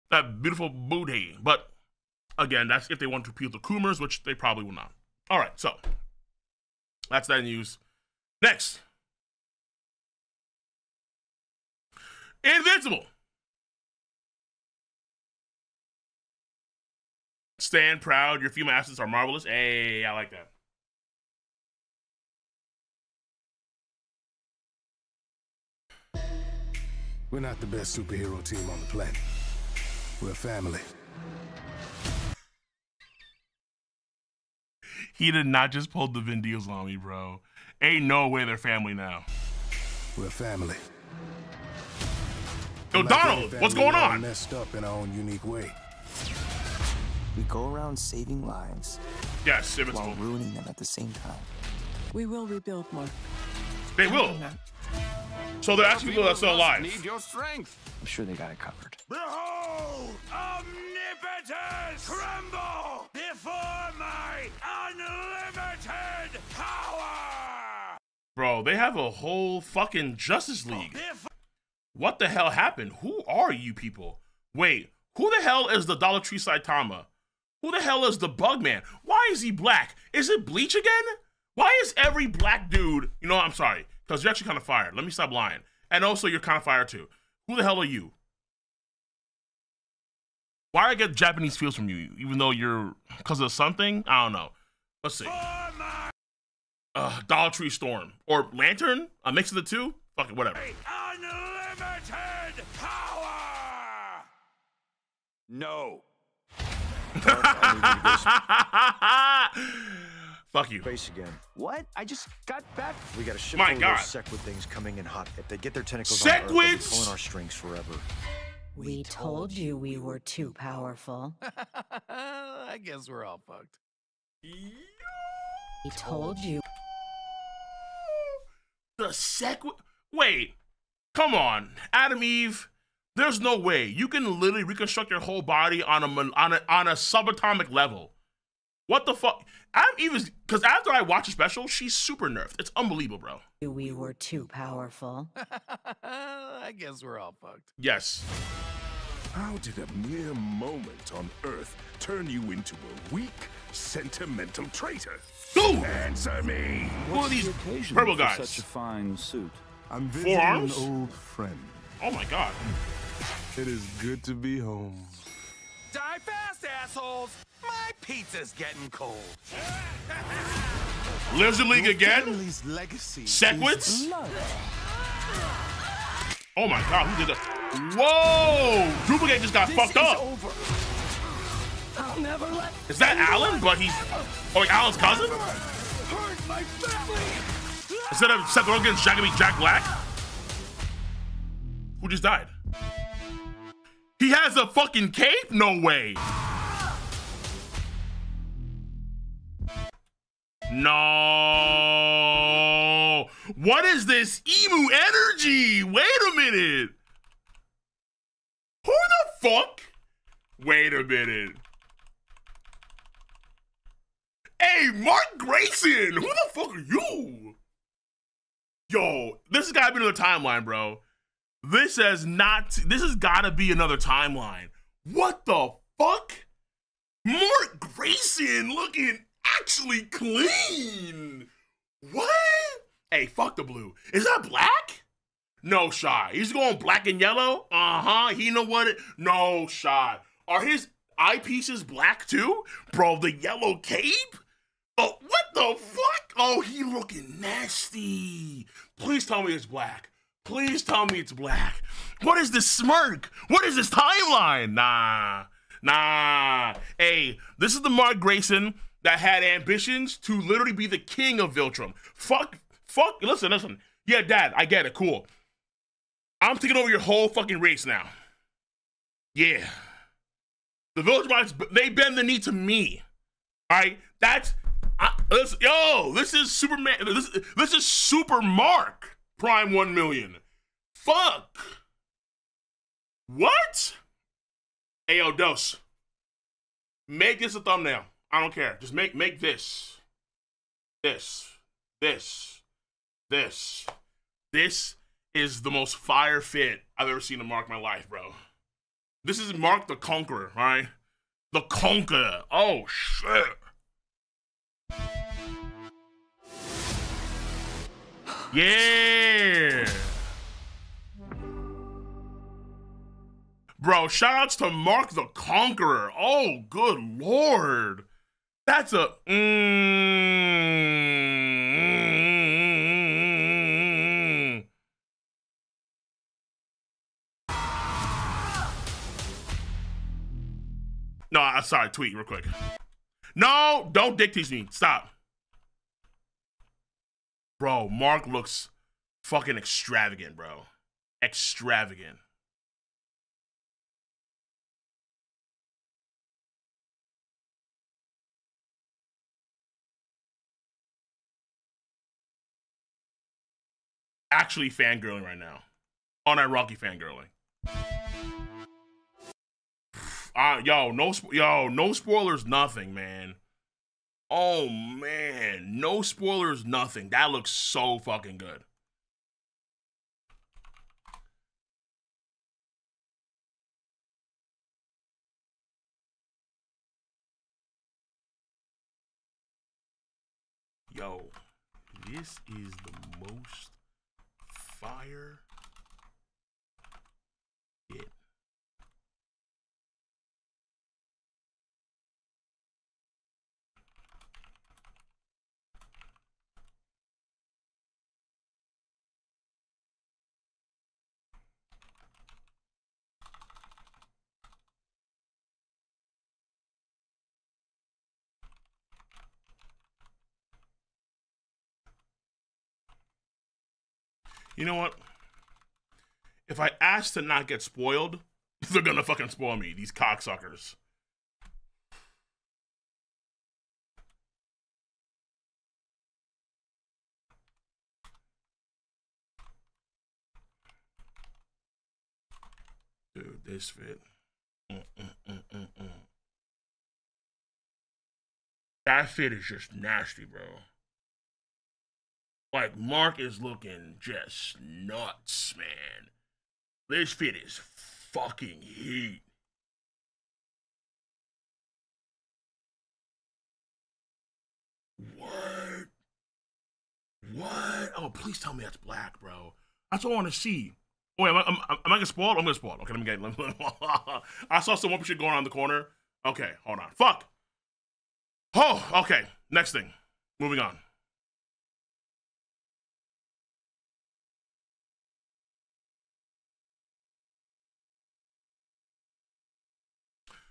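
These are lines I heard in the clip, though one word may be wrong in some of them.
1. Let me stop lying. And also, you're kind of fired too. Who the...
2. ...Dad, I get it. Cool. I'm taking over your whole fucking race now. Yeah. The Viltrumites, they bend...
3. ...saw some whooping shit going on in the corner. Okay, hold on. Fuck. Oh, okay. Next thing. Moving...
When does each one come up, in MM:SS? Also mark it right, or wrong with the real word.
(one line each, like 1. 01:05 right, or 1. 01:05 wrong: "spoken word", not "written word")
1. 01:24 right
2. 04:24 right
3. 07:44 right.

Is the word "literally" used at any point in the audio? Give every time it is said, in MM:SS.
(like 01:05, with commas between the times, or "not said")
02:14, 04:20.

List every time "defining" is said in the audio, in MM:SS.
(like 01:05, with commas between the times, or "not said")
not said.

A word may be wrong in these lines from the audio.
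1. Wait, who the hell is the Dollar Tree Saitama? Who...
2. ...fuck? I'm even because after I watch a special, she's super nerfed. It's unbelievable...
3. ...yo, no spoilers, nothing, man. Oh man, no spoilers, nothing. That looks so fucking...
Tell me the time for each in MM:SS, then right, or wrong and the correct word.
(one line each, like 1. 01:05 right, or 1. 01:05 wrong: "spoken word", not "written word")
1. 01:14 right
2. 02:19 right
3. 06:01 right.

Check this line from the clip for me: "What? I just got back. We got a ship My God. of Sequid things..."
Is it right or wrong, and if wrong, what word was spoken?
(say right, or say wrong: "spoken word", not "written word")
right.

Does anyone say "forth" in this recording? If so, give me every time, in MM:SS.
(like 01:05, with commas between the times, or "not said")
not said.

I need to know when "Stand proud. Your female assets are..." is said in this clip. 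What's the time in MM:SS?
00:17.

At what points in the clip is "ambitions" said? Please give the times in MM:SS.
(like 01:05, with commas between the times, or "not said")
04:19.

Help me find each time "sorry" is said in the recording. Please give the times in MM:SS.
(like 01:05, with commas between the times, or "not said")
01:23, 05:31.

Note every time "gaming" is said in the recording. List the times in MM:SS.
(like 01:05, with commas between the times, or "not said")
not said.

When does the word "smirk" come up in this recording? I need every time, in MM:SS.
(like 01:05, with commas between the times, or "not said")
04:12.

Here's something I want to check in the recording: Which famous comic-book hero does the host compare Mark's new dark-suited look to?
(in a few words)
Superman.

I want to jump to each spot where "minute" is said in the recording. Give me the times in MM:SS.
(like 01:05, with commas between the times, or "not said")
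03:26, 03:31.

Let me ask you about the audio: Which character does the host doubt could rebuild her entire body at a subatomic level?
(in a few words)
Atom Eve.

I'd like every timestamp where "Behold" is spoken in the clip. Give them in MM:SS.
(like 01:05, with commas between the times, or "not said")
00:59.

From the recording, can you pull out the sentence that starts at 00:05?
All right, so that's that news.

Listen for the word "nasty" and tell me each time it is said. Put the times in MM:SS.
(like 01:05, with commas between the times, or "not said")
04:07, 07:19.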